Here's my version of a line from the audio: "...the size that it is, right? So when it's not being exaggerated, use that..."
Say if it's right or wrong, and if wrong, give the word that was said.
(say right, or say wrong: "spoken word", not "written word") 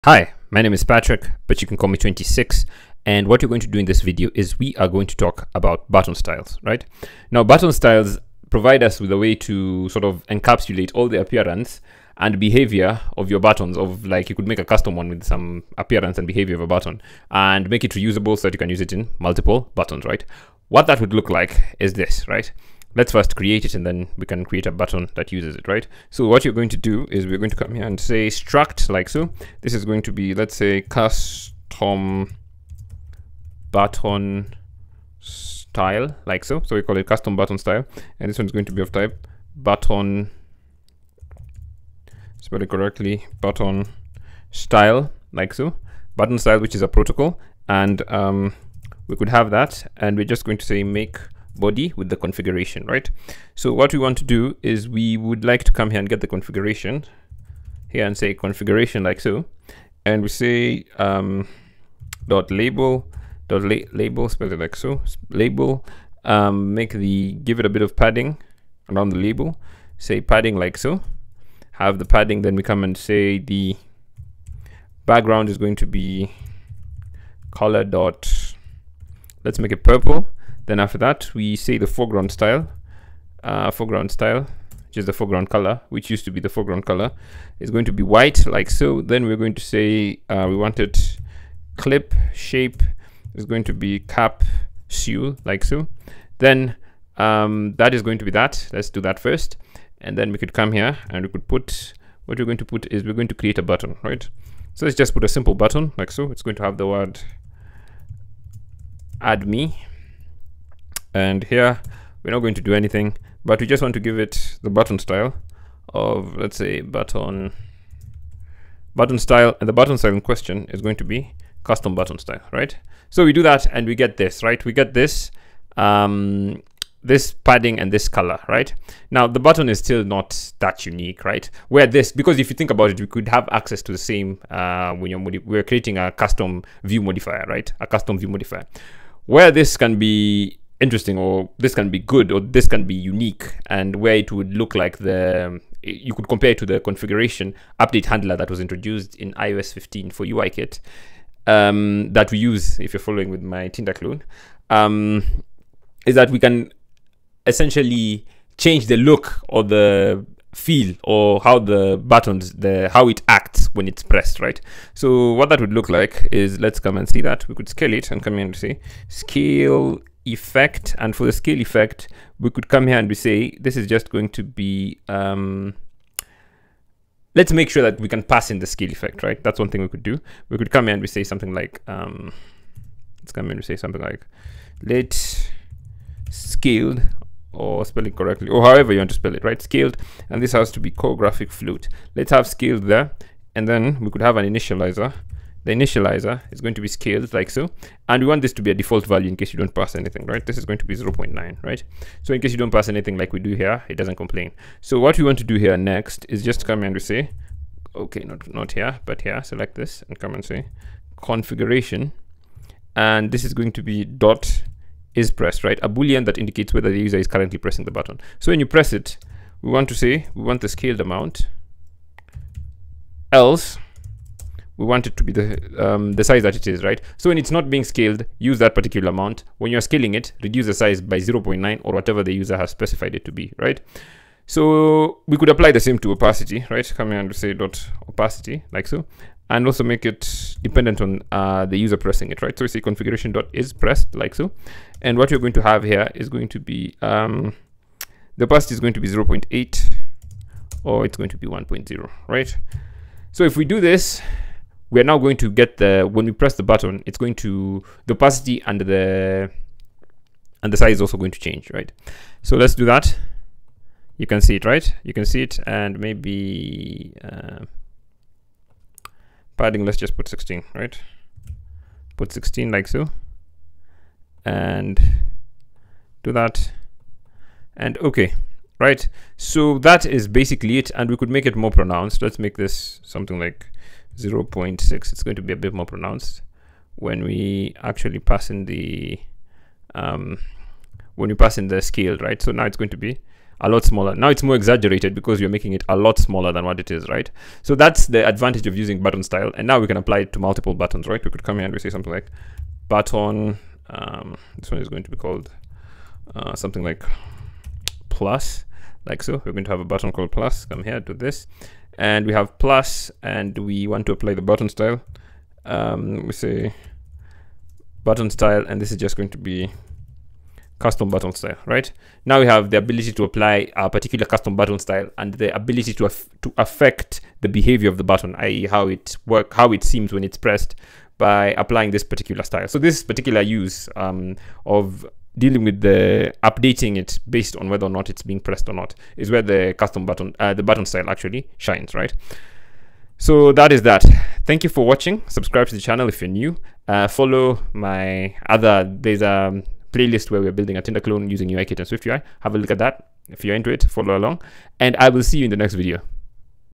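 wrong: "scaled", not "exaggerated".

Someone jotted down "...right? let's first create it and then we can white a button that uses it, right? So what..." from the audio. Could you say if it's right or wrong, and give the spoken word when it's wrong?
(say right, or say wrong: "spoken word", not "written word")
wrong: "create", not "white".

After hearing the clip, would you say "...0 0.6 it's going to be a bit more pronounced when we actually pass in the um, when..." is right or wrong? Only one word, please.
right.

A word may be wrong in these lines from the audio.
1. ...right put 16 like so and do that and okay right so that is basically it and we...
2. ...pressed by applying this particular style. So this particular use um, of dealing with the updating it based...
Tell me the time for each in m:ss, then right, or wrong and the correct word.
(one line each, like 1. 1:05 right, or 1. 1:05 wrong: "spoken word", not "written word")
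1. 4:30 right
2. 5:30 right.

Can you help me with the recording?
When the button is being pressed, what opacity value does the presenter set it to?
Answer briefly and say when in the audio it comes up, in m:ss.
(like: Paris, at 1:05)
0.8, at 4:09.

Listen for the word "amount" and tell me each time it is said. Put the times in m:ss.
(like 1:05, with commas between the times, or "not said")
3:41, 3:49.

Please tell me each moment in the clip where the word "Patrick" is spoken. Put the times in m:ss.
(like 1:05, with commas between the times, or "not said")
0:00.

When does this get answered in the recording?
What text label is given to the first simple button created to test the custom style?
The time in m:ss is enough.
1:49.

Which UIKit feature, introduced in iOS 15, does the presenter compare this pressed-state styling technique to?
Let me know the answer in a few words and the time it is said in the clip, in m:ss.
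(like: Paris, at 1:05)
configuration update handler, at 2:26.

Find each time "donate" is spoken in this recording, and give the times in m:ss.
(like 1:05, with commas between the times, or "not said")
not said.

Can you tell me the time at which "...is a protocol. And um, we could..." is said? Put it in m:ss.
0:46.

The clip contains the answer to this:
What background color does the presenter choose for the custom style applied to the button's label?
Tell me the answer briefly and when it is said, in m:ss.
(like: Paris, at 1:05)
purple, at 1:19.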